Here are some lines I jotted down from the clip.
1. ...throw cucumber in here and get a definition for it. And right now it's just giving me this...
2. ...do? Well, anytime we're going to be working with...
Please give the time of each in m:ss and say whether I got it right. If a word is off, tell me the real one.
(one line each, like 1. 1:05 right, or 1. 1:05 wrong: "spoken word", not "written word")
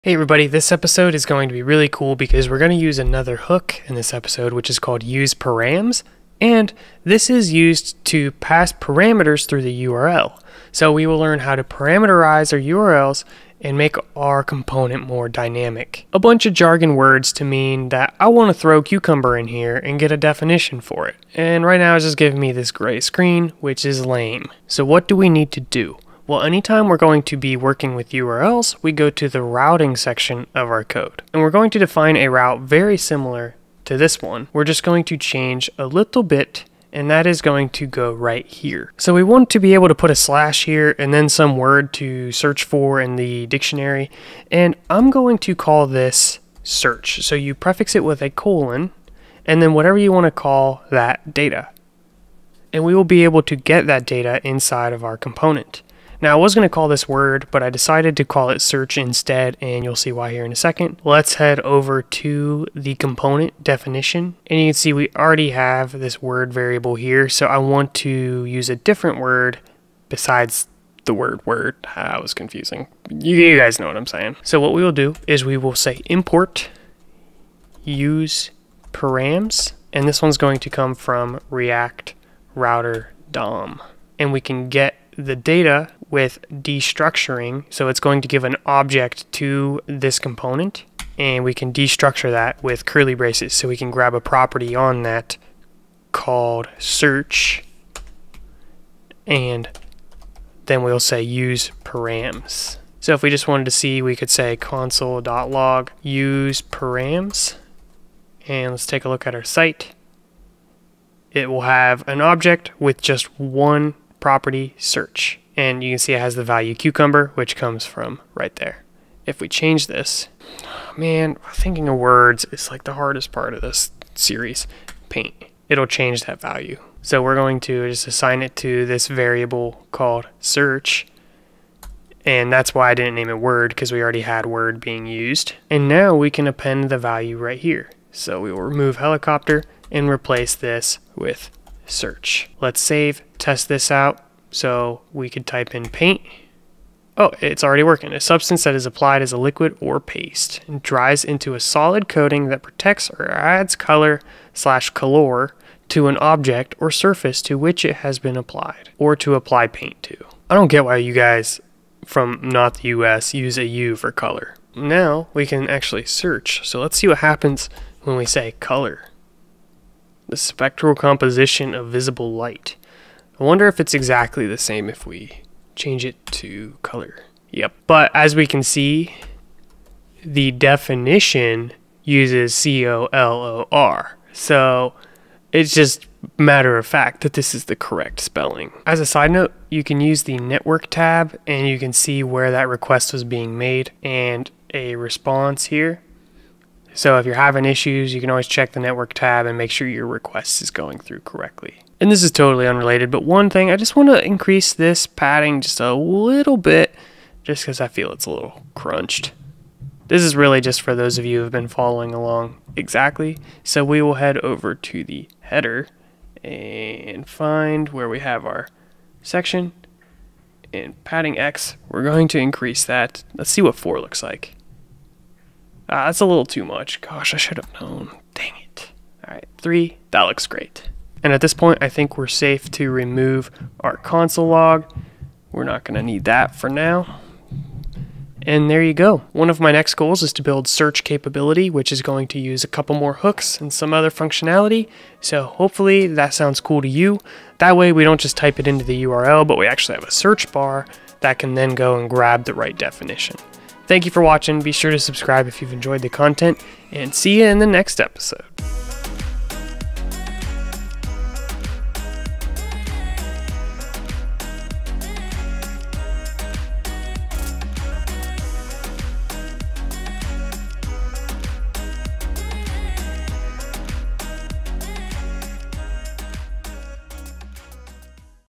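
1. 0:18 right
2. 0:25 right.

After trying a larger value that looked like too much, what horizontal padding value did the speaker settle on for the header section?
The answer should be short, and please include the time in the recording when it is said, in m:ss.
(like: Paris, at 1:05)
3, at 3:49.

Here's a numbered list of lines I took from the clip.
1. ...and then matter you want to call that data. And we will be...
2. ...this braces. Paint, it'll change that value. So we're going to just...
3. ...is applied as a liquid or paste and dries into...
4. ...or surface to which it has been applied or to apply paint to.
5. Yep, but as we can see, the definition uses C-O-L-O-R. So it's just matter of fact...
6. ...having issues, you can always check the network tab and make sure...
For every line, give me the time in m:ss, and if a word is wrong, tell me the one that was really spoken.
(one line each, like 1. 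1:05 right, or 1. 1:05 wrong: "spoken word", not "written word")
1. 0:49 wrong: "whatever", not "matter"
2. 2:03 wrong: "series", not "braces"
3. 2:28 right
4. 2:36 right
5. 2:57 right
6. 3:17 right.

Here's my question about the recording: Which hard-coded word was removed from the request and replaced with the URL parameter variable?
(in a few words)
helicopter.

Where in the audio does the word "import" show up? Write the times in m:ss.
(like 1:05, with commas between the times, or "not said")
1:16.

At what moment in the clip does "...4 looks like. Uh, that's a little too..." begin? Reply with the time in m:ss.
3:43.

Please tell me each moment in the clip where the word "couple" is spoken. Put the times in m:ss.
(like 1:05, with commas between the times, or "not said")
4:02.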